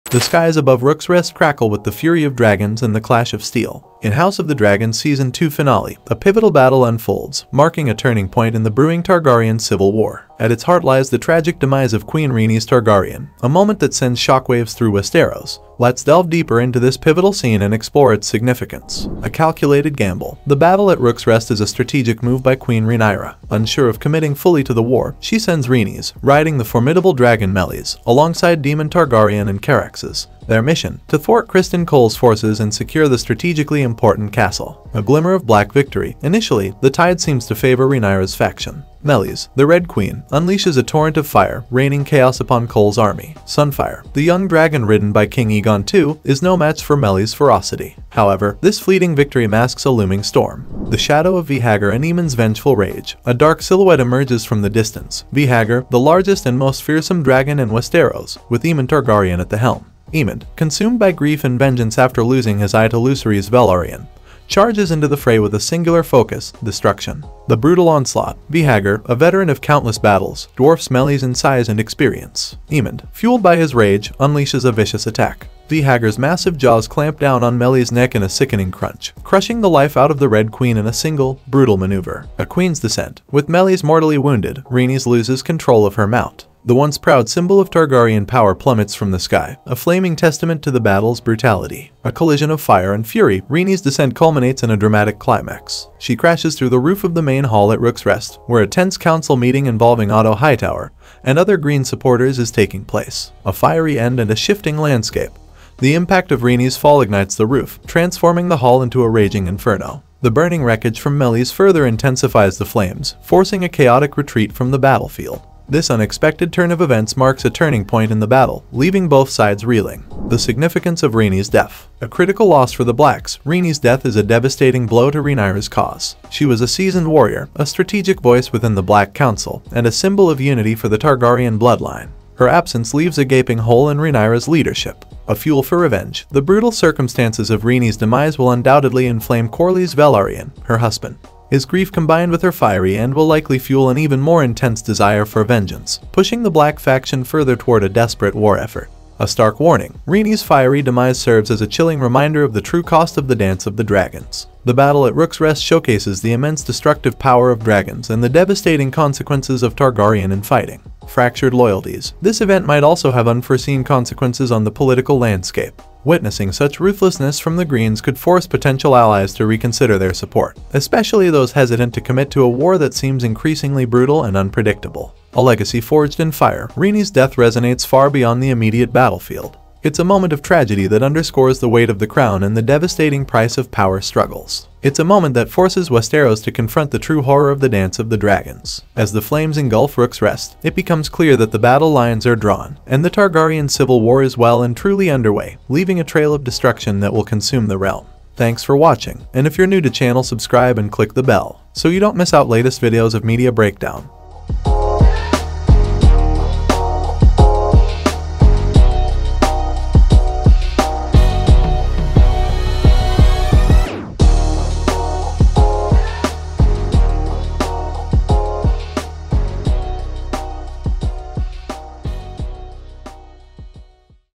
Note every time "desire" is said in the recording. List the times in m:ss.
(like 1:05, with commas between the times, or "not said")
2:24.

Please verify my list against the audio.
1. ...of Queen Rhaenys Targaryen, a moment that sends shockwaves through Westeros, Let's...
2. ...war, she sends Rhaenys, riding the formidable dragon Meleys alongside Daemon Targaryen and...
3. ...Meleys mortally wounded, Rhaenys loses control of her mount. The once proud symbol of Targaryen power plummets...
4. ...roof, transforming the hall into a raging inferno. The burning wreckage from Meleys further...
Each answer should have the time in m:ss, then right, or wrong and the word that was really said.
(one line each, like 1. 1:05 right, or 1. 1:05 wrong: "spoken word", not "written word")
1. 0:11 right
2. 0:24 right
3. 1:23 right
4. 1:47 right.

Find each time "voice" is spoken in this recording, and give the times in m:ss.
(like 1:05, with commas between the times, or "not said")
2:08.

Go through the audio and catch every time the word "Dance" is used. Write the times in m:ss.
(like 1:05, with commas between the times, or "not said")
2:33, 3:07.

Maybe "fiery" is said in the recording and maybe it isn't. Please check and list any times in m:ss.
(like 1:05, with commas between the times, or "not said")
1:43, 2:22, 2:30.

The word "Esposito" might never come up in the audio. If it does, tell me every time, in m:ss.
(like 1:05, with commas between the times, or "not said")
not said.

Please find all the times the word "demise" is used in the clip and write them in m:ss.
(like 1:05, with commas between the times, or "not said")
0:11, 2:17, 2:30.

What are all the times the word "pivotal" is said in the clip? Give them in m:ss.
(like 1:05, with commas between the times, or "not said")
0:06, 0:16.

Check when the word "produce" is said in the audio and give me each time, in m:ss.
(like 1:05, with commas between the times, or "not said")
not said.